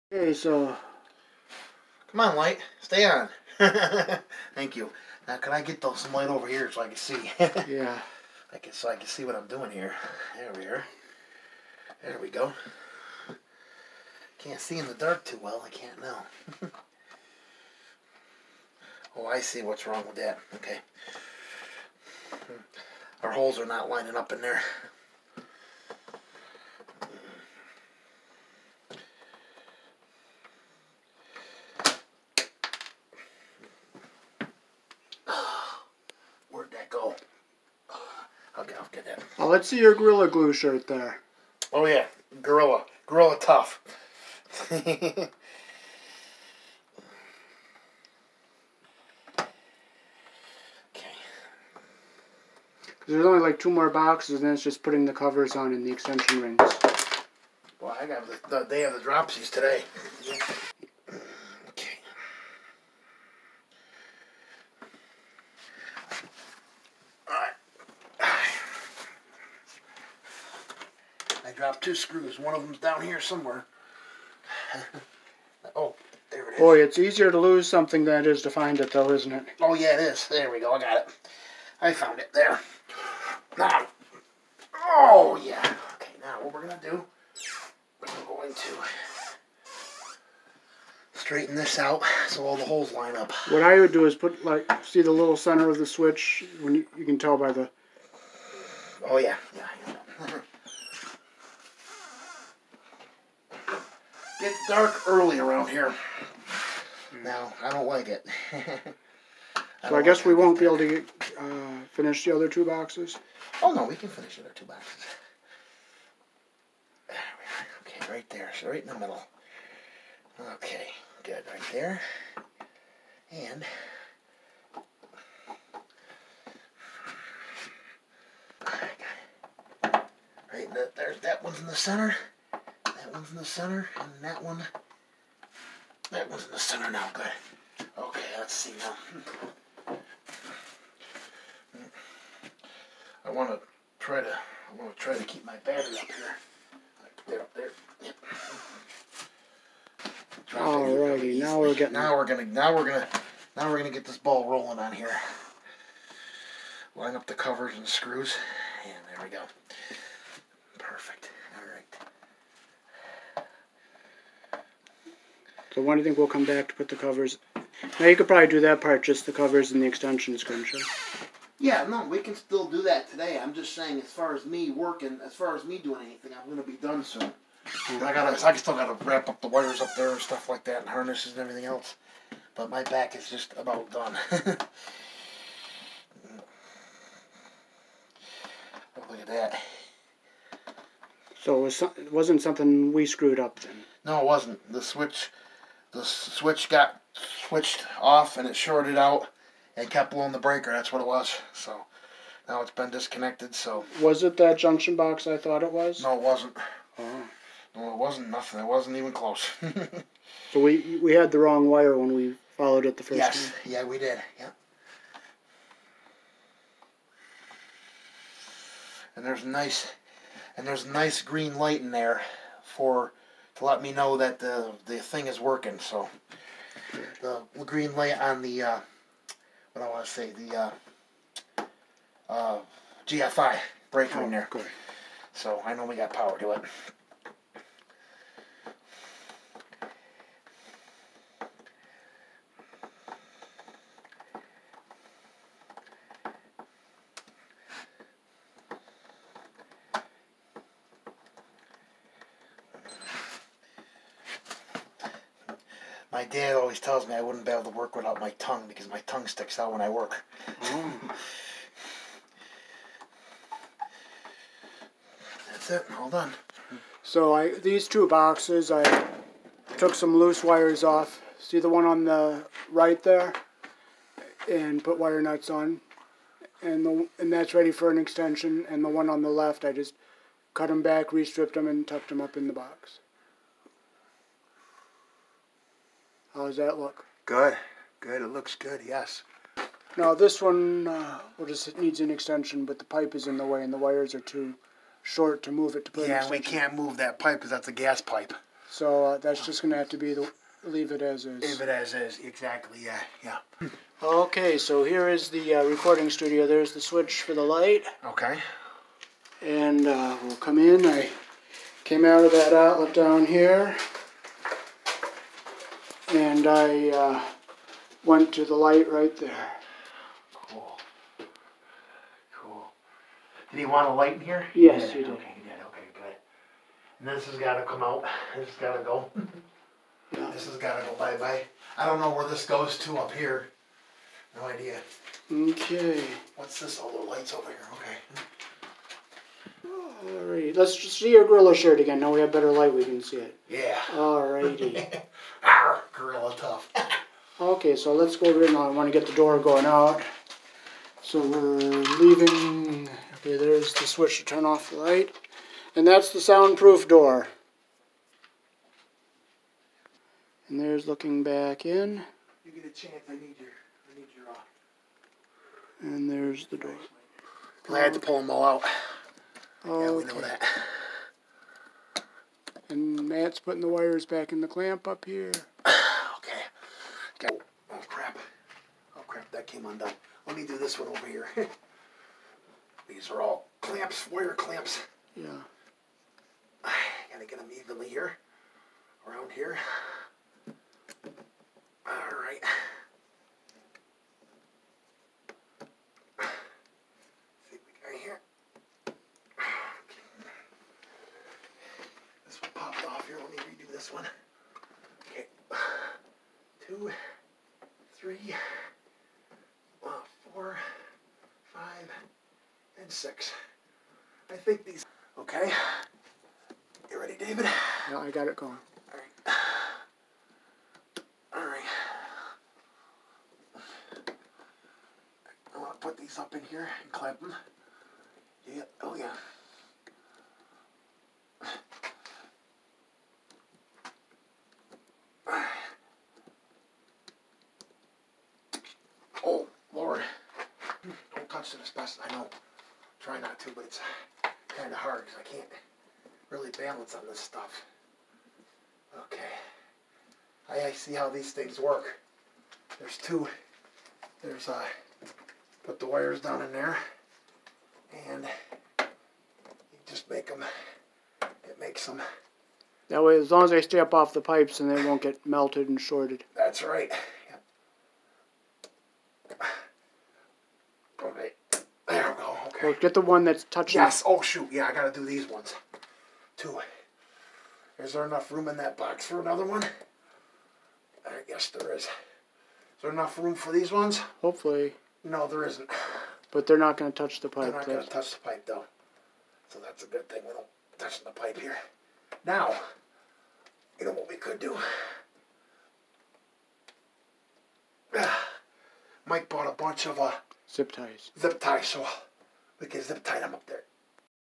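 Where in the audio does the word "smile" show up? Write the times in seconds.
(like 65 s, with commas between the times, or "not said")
not said.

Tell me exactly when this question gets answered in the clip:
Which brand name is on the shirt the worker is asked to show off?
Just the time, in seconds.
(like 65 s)
39 s.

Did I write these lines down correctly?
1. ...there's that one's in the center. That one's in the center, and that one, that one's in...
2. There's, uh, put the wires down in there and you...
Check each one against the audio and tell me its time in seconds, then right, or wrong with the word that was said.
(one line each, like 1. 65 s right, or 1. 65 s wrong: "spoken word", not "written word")
1. 130 s right
2. 454 s right.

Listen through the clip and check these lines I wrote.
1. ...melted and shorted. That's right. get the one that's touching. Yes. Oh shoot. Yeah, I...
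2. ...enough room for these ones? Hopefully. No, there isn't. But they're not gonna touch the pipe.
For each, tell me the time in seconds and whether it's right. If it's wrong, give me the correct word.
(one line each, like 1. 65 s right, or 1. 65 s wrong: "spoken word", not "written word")
1. 465 s right
2. 482 s right.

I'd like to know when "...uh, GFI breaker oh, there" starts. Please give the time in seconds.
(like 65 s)
232 s.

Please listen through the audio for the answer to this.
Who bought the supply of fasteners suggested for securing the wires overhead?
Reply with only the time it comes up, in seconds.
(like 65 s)
499 s.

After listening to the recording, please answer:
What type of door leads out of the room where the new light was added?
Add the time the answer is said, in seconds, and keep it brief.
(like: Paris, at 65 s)
soundproof door, at 356 s.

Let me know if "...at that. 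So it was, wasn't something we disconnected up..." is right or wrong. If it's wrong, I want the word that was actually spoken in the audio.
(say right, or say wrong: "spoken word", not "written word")
wrong: "screwed", not "disconnected".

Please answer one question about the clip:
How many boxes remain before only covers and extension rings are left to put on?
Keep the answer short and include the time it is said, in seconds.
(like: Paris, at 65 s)
2, at 53 s.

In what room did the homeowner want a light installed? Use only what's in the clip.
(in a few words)
recording studio.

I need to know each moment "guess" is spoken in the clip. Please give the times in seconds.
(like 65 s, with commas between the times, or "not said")
110 s, 481 s.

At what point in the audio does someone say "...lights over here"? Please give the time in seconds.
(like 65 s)
337 s.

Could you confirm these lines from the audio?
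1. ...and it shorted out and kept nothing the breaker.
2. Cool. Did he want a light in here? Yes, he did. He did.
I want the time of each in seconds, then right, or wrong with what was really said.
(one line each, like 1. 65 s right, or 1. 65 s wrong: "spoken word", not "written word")
1. 198 s wrong: "blowing", not "nothing"
2. 322 s right.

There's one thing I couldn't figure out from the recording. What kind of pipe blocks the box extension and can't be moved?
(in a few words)
gas pipe.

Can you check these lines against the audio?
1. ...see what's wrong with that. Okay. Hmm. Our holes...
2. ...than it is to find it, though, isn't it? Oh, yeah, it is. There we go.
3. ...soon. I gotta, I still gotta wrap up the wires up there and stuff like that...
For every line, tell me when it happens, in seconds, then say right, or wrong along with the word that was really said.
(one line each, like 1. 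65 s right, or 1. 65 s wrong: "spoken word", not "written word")
1. 19 s right
2. 78 s right
3. 177 s right.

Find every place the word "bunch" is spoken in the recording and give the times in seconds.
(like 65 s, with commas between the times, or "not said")
499 s.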